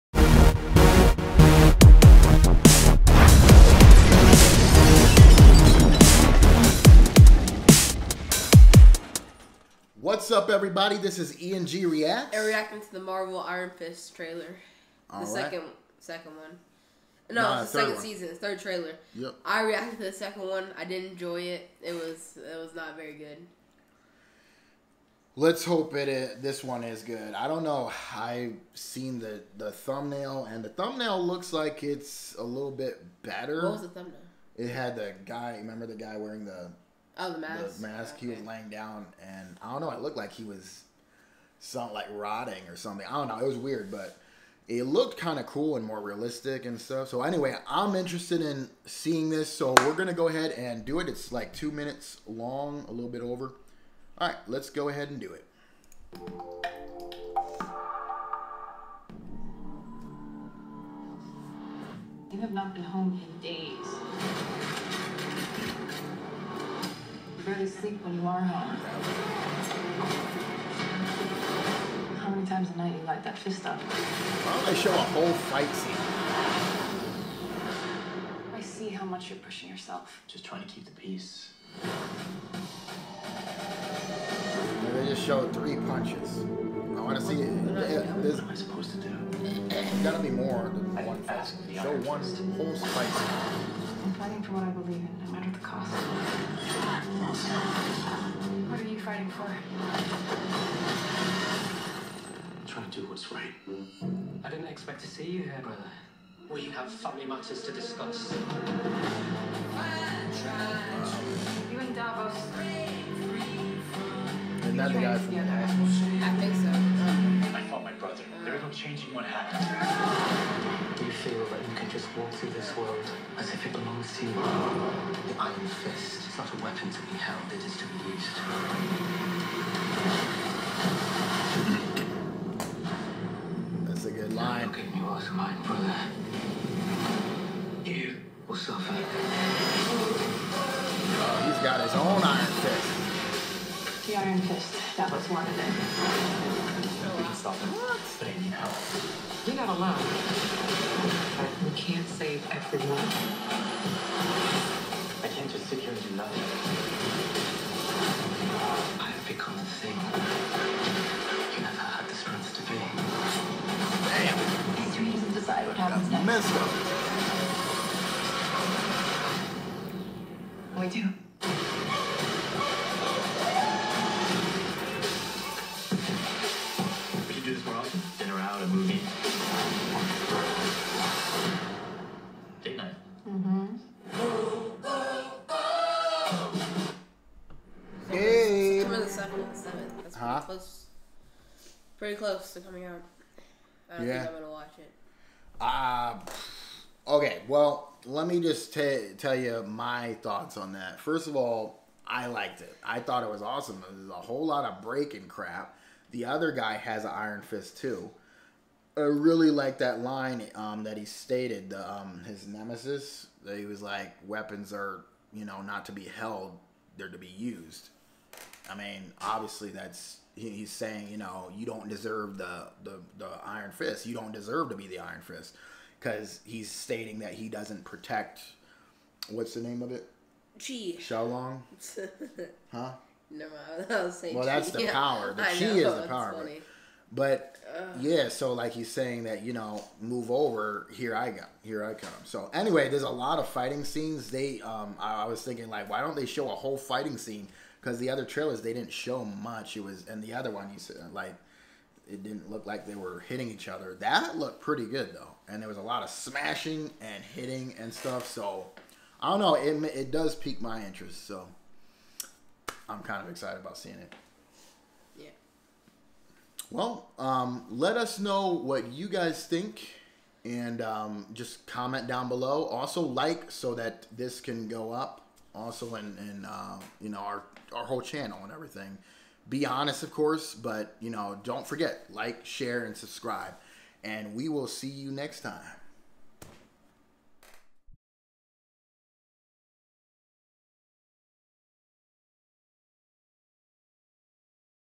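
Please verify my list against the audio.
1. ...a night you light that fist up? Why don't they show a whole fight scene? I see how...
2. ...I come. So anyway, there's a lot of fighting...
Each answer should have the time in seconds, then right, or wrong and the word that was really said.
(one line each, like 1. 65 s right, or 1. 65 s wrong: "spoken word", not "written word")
1. 72 s right
2. 241 s right.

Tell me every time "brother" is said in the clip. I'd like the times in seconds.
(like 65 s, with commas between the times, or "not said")
105 s, 135 s.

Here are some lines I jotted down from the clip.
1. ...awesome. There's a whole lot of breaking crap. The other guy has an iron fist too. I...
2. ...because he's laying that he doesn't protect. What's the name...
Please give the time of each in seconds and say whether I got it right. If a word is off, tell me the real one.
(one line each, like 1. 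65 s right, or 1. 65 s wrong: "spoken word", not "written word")
1. 203 s right
2. 225 s wrong: "stating", not "laying".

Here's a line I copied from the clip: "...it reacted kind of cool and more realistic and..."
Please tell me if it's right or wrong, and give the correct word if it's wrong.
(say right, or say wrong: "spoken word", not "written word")
wrong: "looked", not "reacted".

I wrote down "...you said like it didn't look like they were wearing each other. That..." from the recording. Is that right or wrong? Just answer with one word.
wrong.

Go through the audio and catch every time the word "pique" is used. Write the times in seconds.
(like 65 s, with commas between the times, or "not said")
260 s.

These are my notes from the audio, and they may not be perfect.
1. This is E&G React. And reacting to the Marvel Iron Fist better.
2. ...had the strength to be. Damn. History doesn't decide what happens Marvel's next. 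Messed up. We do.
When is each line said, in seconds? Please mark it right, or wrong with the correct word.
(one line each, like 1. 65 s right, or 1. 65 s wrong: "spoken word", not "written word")
1. 10 s wrong: "trailer", not "better"
2. 161 s wrong: "That", not "Marvel".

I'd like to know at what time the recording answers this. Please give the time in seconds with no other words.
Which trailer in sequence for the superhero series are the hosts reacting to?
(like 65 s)
18 s.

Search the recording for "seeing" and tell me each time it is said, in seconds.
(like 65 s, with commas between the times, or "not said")
48 s, 263 s.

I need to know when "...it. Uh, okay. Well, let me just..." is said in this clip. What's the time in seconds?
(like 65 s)
194 s.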